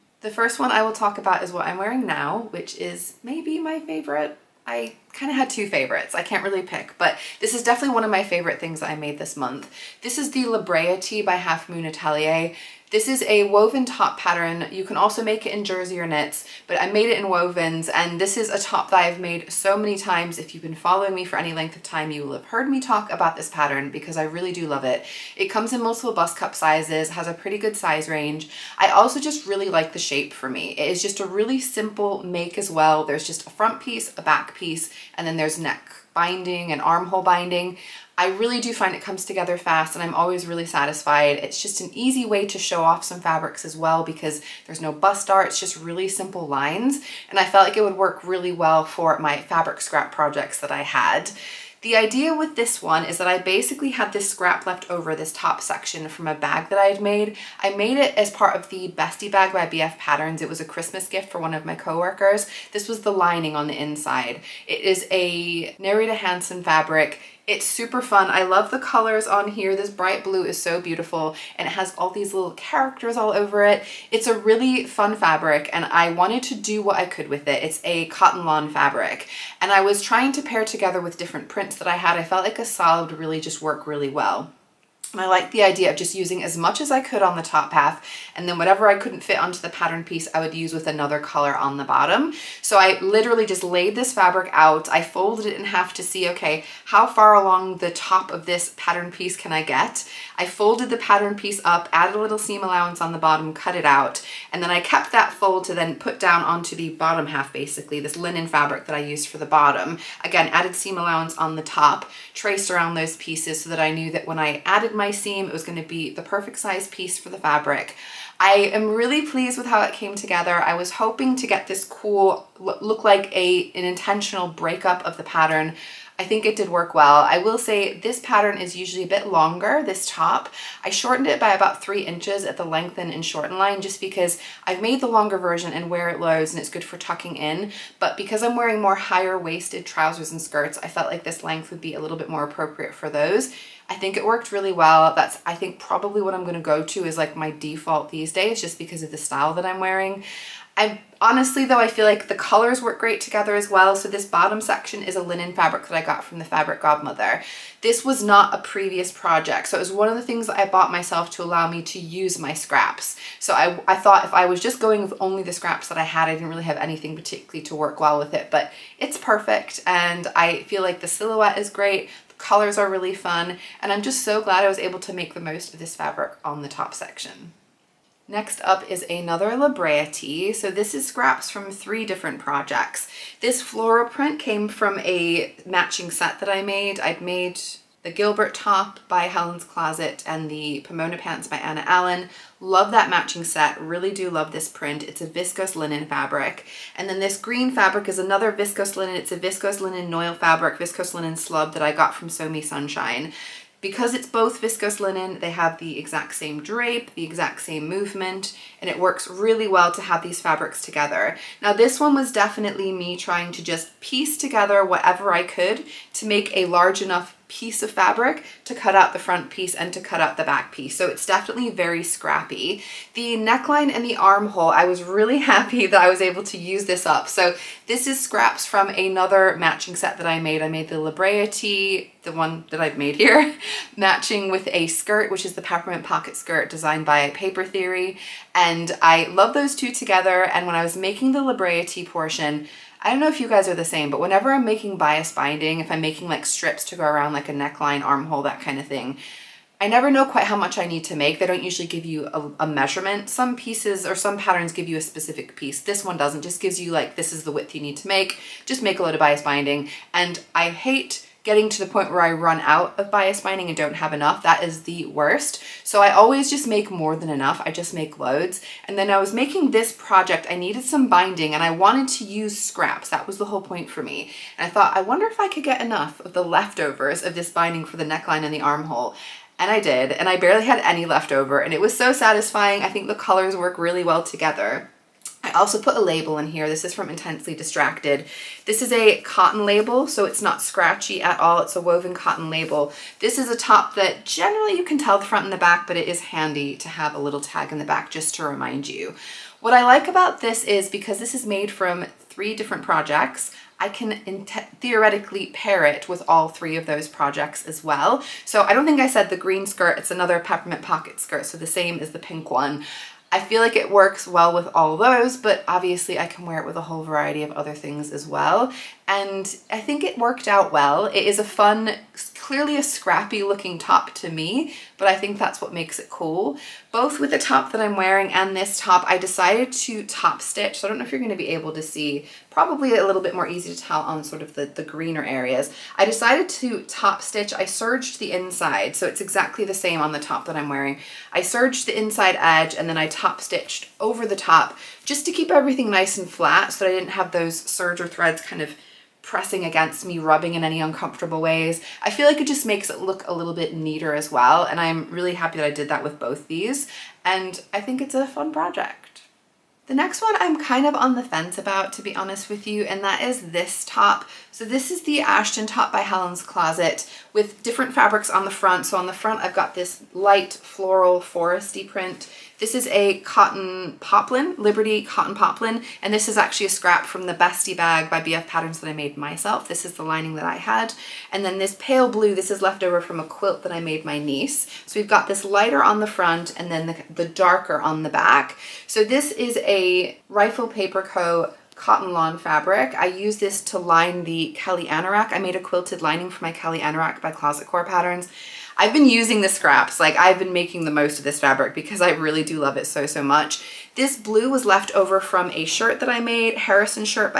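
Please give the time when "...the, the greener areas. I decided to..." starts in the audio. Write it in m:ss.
5:34.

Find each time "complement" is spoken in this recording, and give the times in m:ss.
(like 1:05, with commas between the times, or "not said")
not said.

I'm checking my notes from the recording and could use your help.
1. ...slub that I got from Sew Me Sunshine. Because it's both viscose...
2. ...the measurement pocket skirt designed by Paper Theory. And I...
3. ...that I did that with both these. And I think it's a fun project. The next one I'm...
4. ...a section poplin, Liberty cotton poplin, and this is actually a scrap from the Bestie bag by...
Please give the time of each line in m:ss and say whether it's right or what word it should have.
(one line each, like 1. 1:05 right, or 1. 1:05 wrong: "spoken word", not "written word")
1. 3:21 right
2. 3:55 wrong: "peppermint", not "measurement"
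3. 5:55 right
4. 6:12 wrong: "cotton", not "section".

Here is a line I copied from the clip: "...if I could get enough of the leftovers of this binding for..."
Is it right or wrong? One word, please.
right.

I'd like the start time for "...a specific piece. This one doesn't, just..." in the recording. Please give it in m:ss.
4:14.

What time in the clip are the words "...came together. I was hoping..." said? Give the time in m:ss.
1:59.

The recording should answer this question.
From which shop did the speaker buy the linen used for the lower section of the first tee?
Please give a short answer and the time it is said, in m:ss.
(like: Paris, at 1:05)
Fabric Godmother, at 2:36.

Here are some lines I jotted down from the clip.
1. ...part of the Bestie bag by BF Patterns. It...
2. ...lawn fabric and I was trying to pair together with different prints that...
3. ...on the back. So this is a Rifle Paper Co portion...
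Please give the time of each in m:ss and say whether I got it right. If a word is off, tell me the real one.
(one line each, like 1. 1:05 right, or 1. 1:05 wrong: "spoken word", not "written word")
1. 0:58 right
2. 1:18 right
3. 6:27 wrong: "cotton", not "portion".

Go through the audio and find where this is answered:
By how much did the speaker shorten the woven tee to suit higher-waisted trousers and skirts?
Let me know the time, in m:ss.
2:11.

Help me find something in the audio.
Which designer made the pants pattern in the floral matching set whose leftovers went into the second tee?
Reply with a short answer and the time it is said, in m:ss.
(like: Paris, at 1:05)
Anna Allen, at 3:11.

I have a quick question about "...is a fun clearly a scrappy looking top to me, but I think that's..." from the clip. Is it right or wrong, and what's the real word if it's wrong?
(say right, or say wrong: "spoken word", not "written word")
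right.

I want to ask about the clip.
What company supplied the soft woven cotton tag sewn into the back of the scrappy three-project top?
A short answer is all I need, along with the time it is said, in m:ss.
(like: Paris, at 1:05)
Intensely Distracted, at 4:47.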